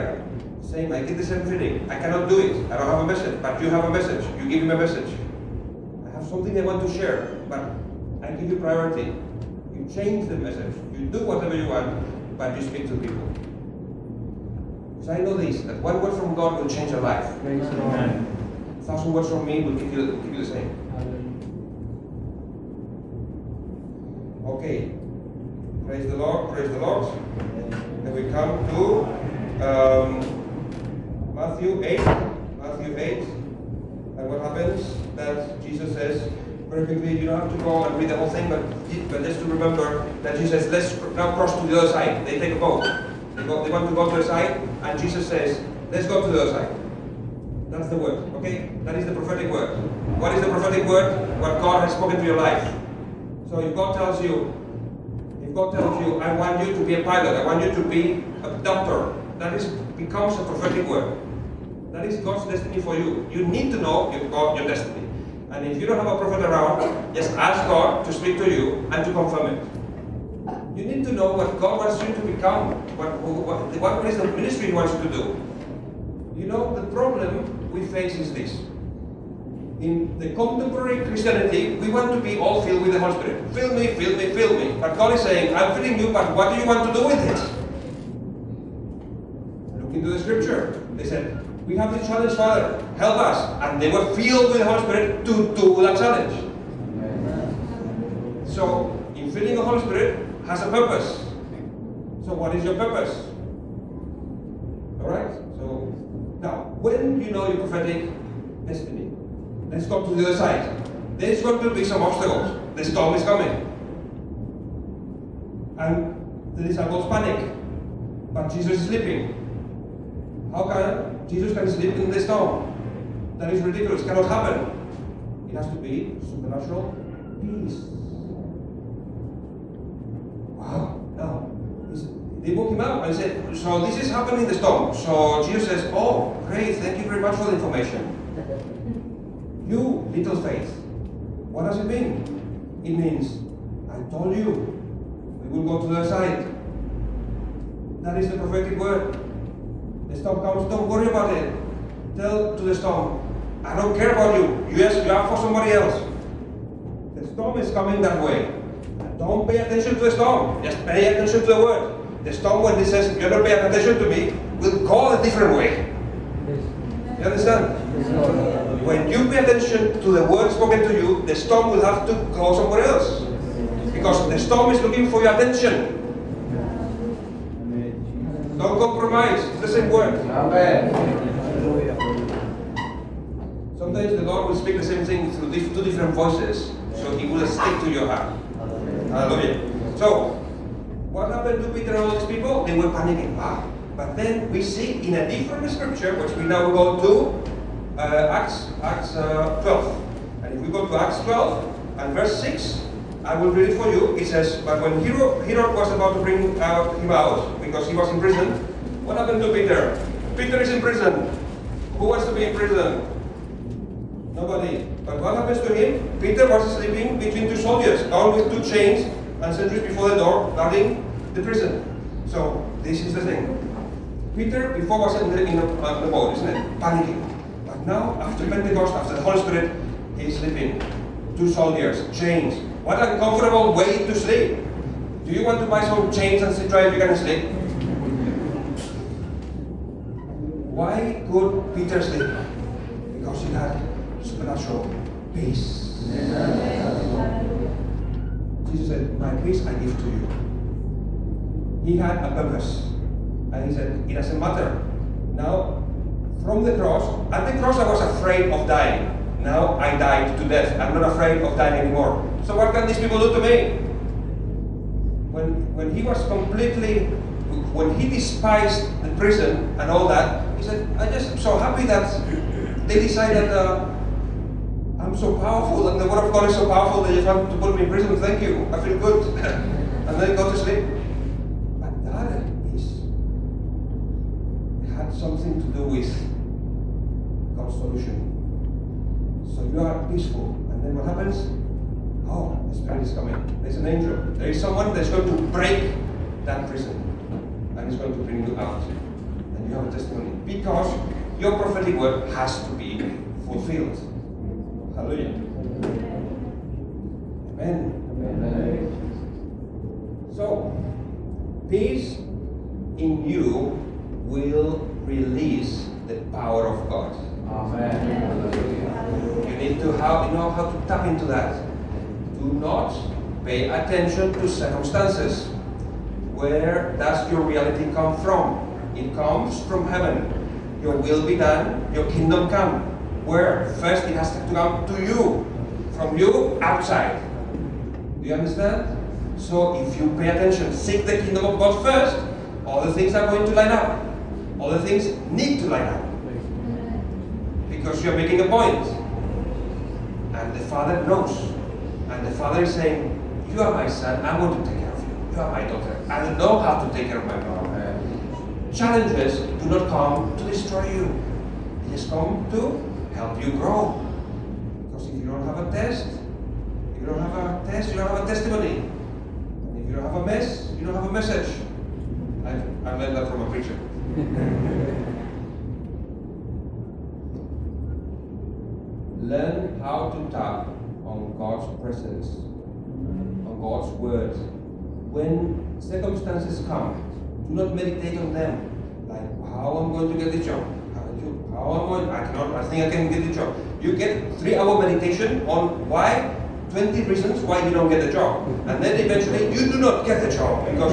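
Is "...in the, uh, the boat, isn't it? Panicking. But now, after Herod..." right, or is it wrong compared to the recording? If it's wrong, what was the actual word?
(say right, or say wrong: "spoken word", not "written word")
wrong: "Pentecost", not "Herod".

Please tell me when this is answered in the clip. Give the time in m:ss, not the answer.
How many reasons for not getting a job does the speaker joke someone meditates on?
6:36.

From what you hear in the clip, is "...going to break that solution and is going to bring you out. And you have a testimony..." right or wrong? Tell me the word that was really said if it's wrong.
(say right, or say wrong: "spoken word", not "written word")
wrong: "prison", not "solution".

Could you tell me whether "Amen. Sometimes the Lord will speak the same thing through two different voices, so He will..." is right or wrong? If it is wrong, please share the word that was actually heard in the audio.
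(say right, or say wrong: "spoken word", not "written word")
right.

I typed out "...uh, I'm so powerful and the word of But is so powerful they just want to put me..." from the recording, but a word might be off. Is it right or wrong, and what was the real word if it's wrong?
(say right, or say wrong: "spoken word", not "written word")
wrong: "God", not "But".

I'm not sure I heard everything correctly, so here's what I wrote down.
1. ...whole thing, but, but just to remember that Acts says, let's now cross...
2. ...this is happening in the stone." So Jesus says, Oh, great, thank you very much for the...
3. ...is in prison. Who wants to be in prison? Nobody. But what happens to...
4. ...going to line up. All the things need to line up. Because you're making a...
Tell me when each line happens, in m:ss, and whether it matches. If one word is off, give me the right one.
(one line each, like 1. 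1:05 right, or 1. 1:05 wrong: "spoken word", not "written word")
1. 0:38 wrong: "Jesus", not "Acts"
2. 2:13 right
3. 3:30 right
4. 5:43 right.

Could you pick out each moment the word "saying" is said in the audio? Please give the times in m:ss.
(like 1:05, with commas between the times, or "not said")
0:00, 1:25, 5:52.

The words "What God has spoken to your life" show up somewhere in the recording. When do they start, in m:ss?
0:51.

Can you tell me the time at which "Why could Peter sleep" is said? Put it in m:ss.
4:00.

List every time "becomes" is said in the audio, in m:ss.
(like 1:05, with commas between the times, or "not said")
0:59, 1:12.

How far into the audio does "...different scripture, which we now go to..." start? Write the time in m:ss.
3:15.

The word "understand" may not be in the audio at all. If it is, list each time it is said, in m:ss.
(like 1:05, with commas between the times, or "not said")
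2:47, 5:38.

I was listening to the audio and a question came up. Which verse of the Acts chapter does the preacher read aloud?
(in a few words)
verse 6.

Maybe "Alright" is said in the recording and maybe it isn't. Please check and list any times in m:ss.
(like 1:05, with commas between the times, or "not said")
1:45.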